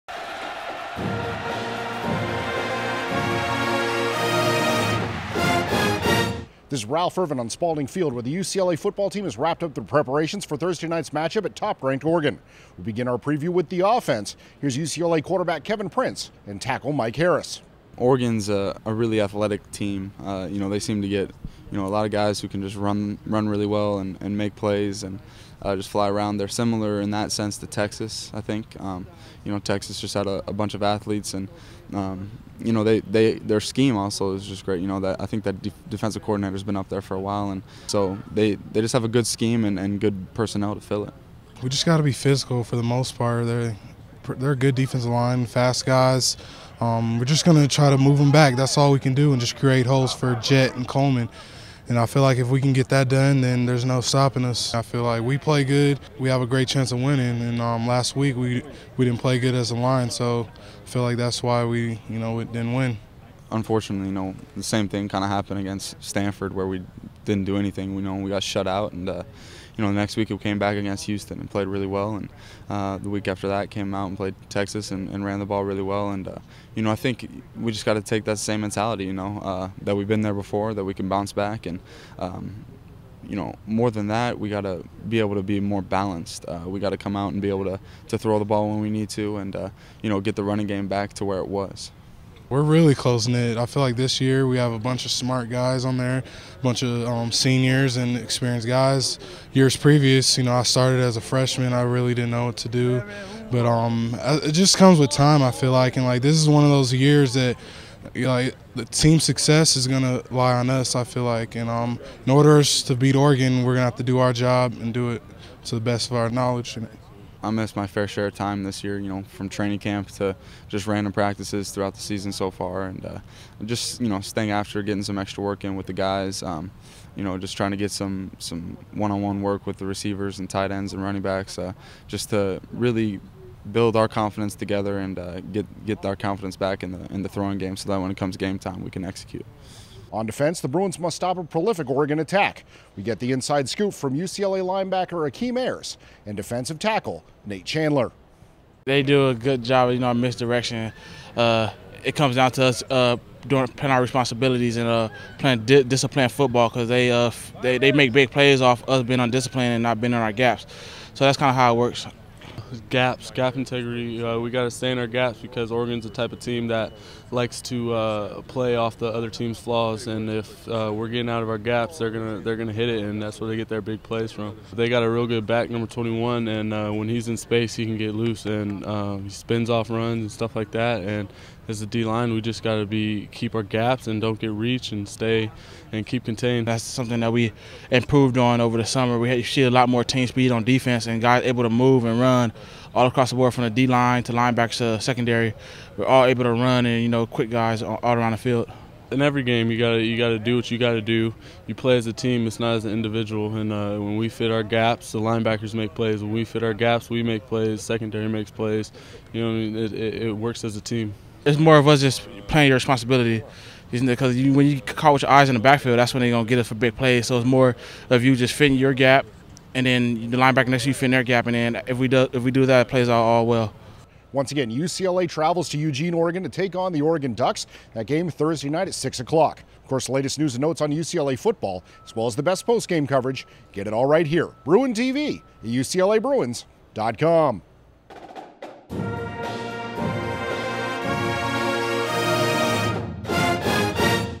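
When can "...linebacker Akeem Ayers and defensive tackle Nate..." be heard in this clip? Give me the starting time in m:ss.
2:24.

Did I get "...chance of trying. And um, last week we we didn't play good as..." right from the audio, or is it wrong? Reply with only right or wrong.
wrong.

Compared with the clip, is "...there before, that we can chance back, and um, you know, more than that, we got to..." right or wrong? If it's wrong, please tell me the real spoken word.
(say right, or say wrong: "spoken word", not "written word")
wrong: "bounce", not "chance".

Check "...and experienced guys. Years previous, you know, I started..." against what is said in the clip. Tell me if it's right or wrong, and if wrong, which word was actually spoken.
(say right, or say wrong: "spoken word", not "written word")
right.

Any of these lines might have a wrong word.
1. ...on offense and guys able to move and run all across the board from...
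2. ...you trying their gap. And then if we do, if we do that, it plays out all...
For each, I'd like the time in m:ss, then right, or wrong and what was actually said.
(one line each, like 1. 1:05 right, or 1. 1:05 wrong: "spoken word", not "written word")
1. 3:10 wrong: "defense", not "offense"
2. 3:40 wrong: "fitting", not "trying".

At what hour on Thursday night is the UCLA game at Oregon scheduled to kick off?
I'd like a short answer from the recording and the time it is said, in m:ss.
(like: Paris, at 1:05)
6 o'clock, at 3:48.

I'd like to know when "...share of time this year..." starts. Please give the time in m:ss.
1:58.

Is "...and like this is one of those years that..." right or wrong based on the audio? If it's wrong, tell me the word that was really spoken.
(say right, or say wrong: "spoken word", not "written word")
right.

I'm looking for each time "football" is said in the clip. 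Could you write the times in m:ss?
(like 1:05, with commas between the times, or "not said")
0:08, 2:36, 3:51.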